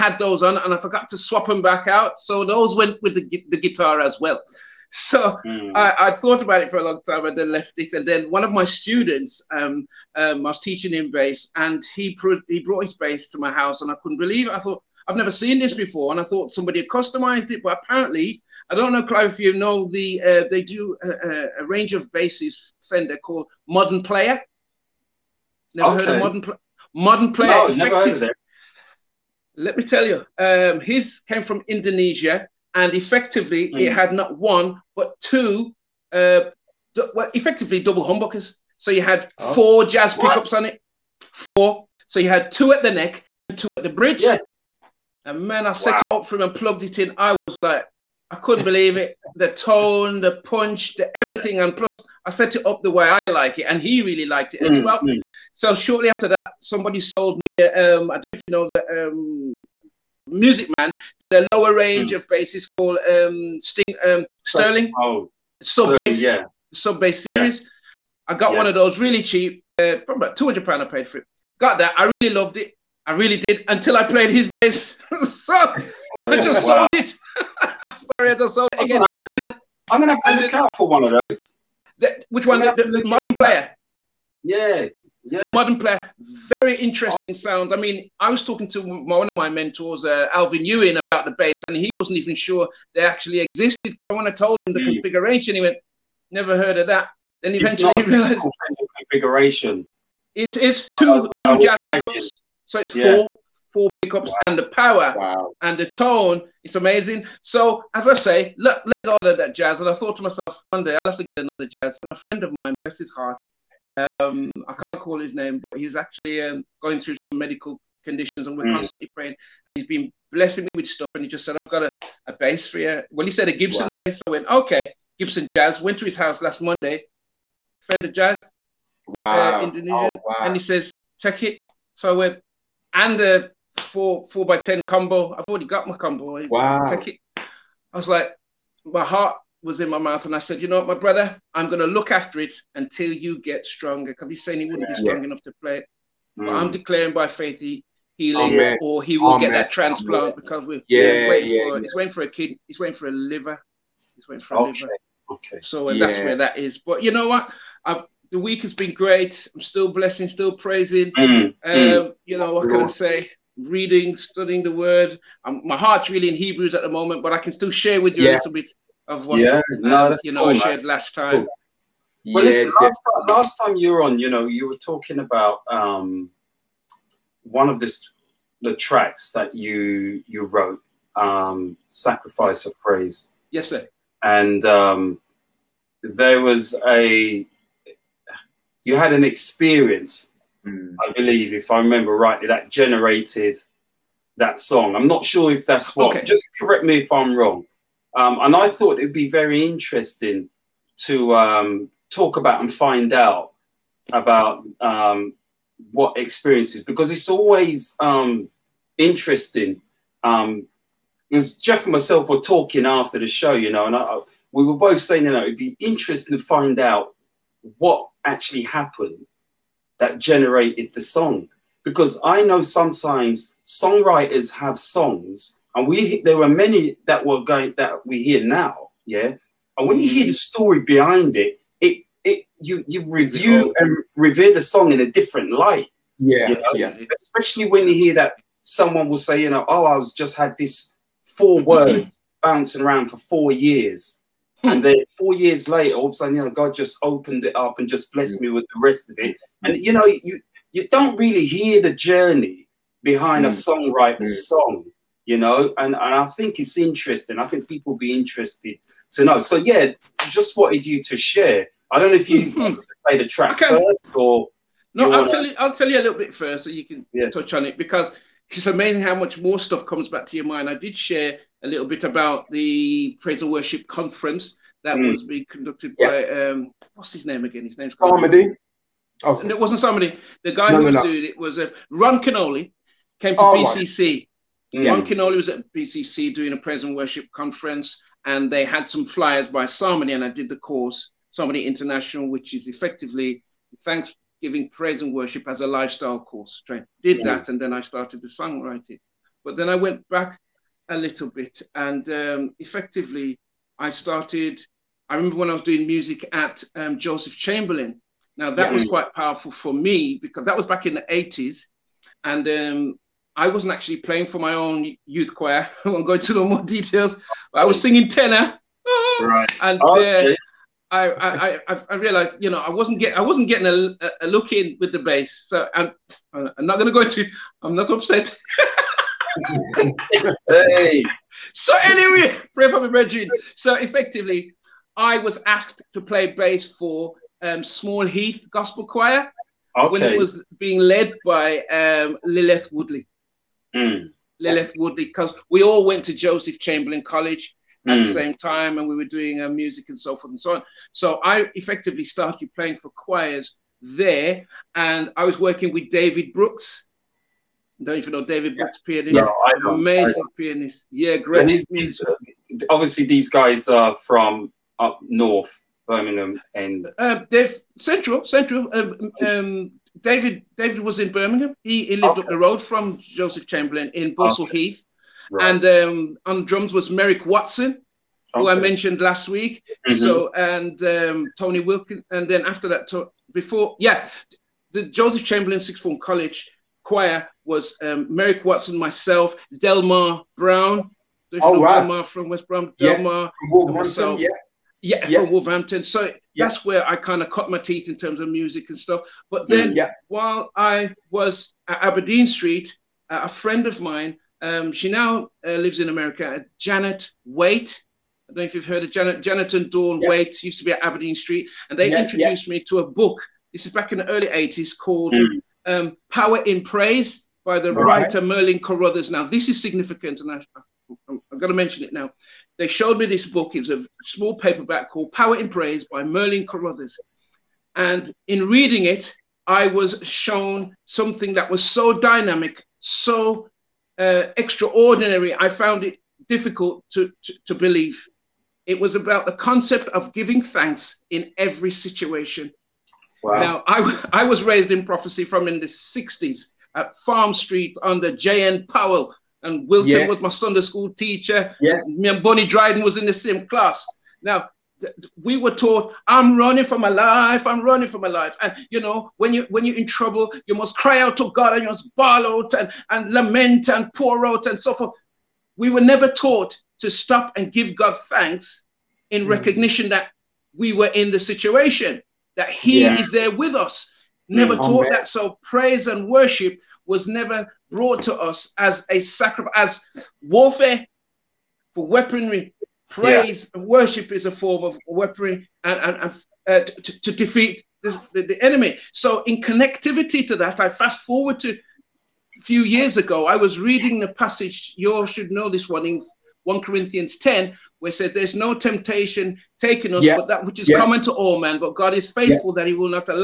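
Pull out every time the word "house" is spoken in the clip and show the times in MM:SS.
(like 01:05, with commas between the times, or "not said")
00:13, 02:06.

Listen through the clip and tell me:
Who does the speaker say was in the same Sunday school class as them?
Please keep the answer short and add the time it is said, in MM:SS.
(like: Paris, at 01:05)
Bonnie Dryden, at 07:32.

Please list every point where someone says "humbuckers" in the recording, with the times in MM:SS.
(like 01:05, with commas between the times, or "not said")
00:38.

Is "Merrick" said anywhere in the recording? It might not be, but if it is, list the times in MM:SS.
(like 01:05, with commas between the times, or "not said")
06:16, 06:28.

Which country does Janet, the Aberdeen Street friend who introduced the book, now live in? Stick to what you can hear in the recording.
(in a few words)
America.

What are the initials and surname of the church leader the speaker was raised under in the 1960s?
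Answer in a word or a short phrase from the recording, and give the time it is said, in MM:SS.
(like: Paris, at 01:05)
J.N. Powell, at 07:28.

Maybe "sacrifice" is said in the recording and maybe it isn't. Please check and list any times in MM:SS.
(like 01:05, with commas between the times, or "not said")
03:01, 07:58.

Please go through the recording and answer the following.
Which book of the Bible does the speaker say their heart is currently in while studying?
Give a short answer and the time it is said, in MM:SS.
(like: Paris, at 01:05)
Hebrews, at 02:46.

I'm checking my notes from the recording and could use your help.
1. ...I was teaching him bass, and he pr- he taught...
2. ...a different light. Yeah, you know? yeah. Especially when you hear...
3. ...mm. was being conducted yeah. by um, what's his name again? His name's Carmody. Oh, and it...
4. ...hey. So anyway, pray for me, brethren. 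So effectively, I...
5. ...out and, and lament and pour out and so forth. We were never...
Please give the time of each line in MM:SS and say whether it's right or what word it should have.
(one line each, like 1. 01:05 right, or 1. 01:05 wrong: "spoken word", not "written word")
1. 00:10 wrong: "brought", not "taught"
2. 03:54 right
3. 04:34 right
4. 05:30 right
5. 07:42 right.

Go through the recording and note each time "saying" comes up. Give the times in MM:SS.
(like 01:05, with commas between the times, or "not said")
02:24, 03:34.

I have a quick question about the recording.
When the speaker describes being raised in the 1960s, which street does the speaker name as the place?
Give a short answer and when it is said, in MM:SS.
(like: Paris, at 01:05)
Farm Street, at 07:26.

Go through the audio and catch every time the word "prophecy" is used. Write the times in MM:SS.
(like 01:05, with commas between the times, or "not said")
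07:24.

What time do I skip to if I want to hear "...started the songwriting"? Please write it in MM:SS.
04:57.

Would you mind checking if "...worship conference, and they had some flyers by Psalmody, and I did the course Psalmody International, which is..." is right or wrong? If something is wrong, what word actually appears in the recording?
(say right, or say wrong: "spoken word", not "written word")
right.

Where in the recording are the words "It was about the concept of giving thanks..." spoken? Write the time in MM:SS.
07:18.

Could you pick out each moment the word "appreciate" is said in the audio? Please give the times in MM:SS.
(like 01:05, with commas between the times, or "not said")
not said.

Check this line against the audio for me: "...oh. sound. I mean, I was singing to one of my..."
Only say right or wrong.
wrong.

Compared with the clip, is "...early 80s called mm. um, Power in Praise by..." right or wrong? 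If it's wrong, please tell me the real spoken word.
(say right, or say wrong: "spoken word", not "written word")
right.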